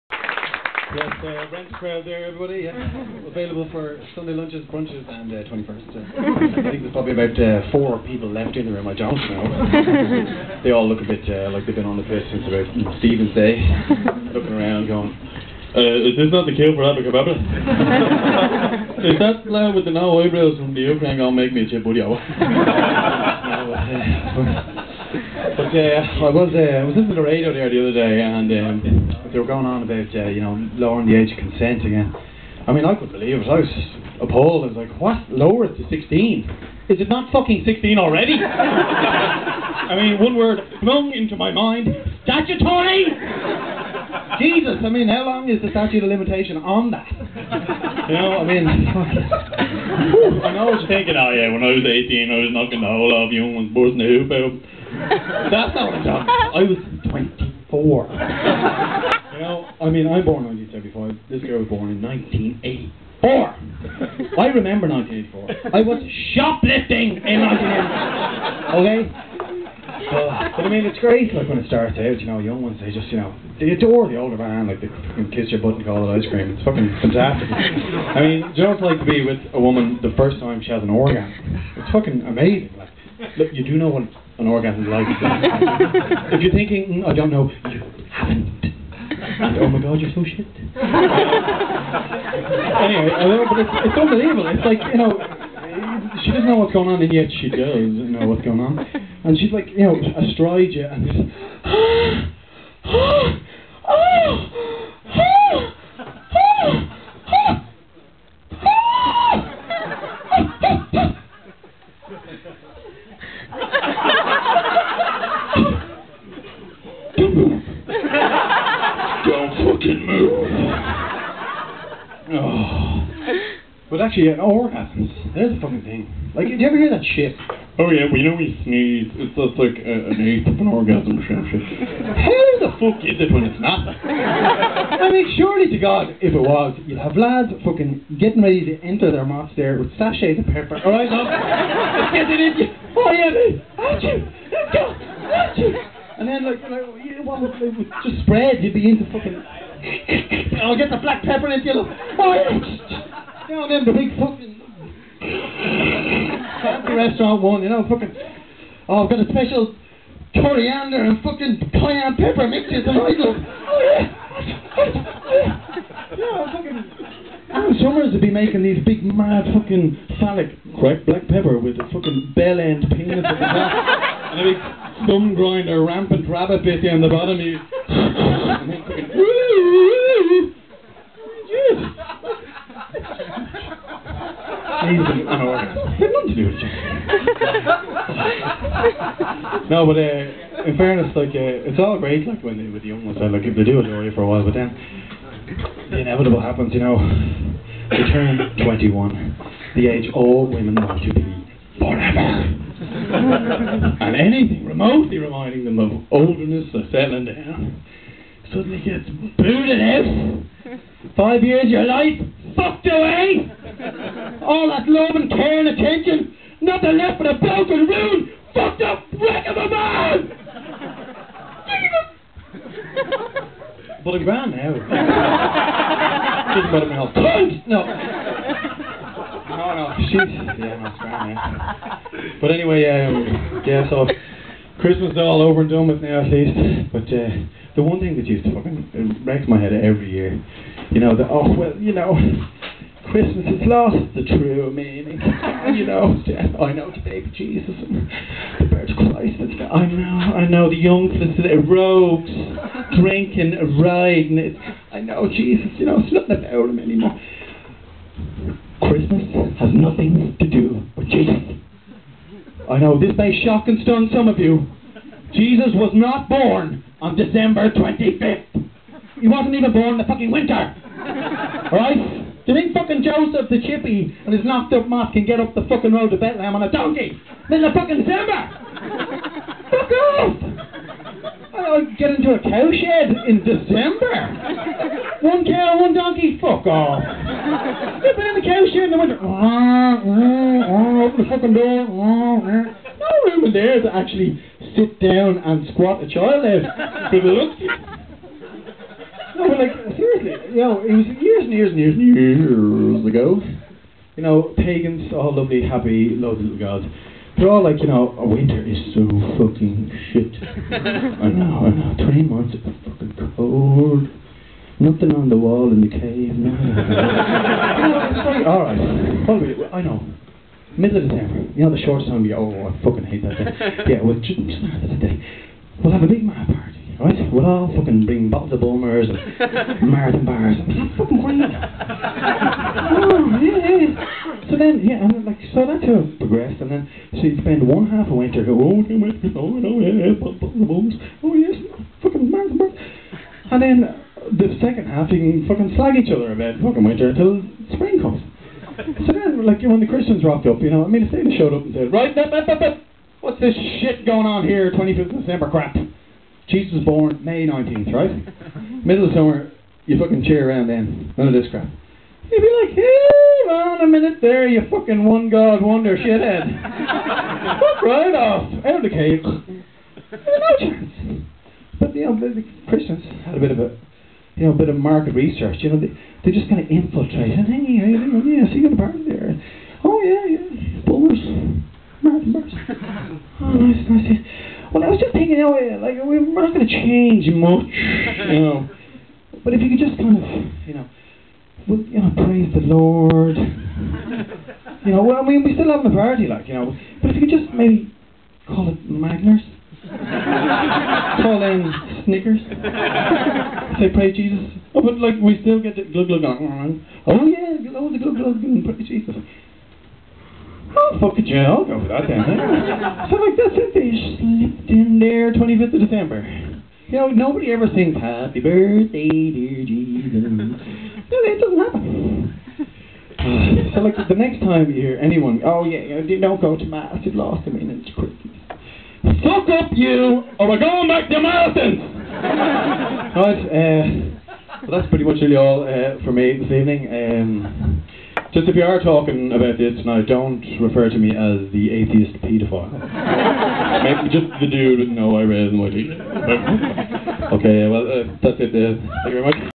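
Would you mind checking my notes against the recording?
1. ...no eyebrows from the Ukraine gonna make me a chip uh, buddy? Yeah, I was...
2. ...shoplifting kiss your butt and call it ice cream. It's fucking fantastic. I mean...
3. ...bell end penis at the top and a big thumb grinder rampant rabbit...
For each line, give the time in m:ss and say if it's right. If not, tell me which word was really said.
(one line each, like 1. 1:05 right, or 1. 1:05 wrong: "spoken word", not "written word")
1. 0:19 right
2. 1:14 wrong: "fucking", not "shoplifting"
3. 2:52 right.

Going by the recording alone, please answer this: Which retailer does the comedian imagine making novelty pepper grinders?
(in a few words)
Ann Summers.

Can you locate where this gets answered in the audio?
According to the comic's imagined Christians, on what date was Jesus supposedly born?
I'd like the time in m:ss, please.
5:57.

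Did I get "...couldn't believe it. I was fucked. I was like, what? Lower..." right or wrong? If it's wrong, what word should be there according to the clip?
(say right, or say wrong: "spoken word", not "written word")
wrong: "appalled", not "fucked".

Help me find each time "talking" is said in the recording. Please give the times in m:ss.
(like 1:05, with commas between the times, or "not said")
0:56, 7:18.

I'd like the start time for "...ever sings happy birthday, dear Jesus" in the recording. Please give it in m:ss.
6:57.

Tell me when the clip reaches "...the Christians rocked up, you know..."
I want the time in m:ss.
5:49.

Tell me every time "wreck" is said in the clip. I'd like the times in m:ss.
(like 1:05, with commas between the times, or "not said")
3:39, 3:59.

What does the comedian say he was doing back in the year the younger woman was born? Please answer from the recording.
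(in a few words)
Shoplifting.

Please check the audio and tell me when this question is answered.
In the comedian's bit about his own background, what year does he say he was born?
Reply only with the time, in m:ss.
1:00.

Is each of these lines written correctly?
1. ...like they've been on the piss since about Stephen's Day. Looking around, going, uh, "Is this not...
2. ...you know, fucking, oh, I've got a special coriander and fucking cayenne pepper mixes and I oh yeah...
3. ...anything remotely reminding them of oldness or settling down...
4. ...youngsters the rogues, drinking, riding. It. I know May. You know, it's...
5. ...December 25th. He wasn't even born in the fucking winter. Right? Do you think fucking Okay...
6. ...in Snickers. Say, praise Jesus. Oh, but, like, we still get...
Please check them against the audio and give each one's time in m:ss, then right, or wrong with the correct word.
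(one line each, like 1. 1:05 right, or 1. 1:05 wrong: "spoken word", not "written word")
1. 0:11 right
2. 2:37 right
3. 3:24 right
4. 4:10 wrong: "Jesus", not "May"
5. 4:27 wrong: "Joseph", not "Okay"
6. 6:41 right.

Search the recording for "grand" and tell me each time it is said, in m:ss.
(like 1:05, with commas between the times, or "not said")
3:44, 3:50.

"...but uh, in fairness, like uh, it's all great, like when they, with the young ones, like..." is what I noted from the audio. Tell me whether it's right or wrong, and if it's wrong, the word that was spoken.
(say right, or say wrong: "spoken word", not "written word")
right.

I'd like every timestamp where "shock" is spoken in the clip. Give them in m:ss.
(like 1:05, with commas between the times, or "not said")
4:23.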